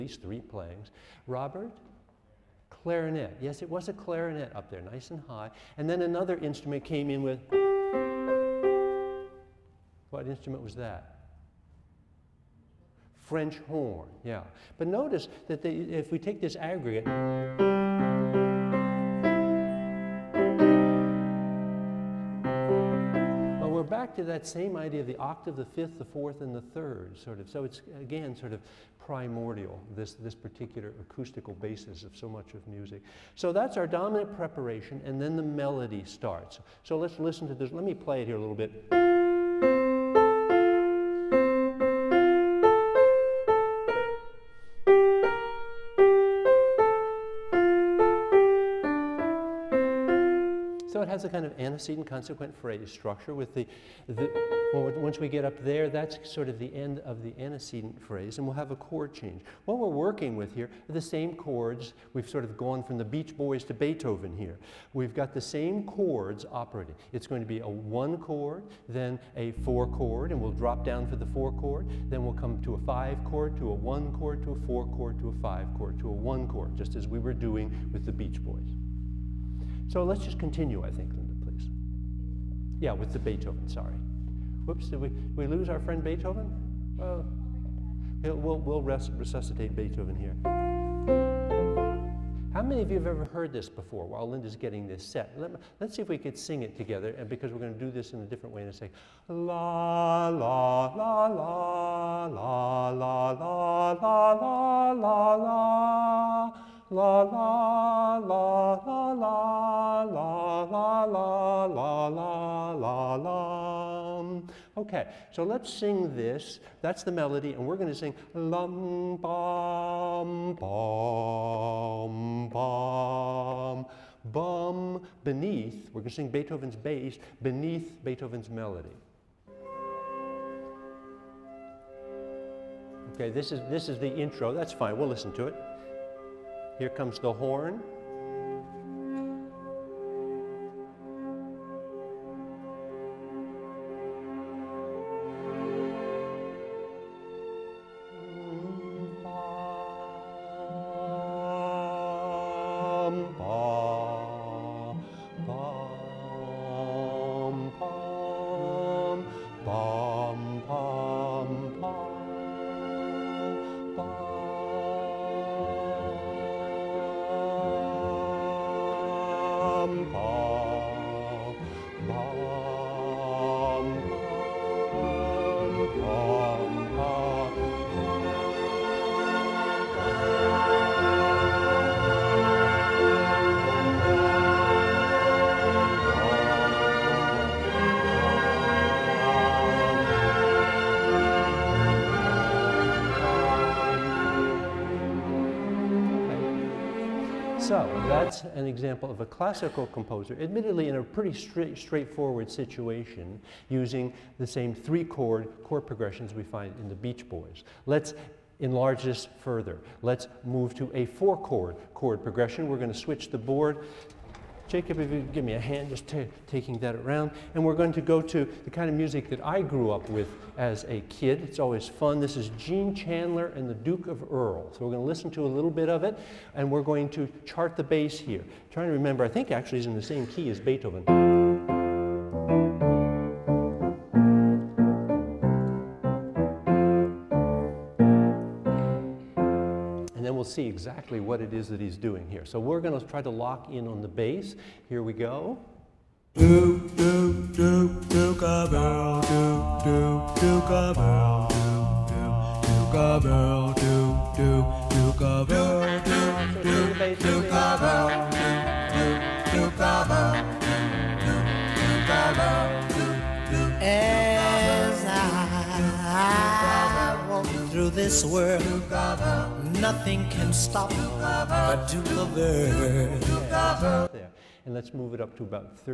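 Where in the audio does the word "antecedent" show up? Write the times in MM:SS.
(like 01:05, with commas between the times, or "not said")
00:51, 00:57.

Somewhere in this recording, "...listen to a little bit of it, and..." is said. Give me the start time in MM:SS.
03:45.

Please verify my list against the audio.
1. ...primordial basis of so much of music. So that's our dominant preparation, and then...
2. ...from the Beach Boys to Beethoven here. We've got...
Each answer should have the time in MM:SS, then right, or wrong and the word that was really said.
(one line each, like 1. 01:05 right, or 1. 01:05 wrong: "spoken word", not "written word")
1. 00:30 wrong: "acoustical", not "primordial"
2. 01:02 right.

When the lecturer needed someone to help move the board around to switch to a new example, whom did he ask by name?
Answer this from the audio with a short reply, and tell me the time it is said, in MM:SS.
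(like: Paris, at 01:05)
Jacob, at 03:34.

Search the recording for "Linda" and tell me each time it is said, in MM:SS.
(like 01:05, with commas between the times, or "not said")
01:21, 01:34.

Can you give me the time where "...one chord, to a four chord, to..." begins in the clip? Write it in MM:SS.
01:13.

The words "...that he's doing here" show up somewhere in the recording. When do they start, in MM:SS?
04:01.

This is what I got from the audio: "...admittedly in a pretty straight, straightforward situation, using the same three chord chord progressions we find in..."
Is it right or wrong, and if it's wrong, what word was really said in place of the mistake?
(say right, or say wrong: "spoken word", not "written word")
right.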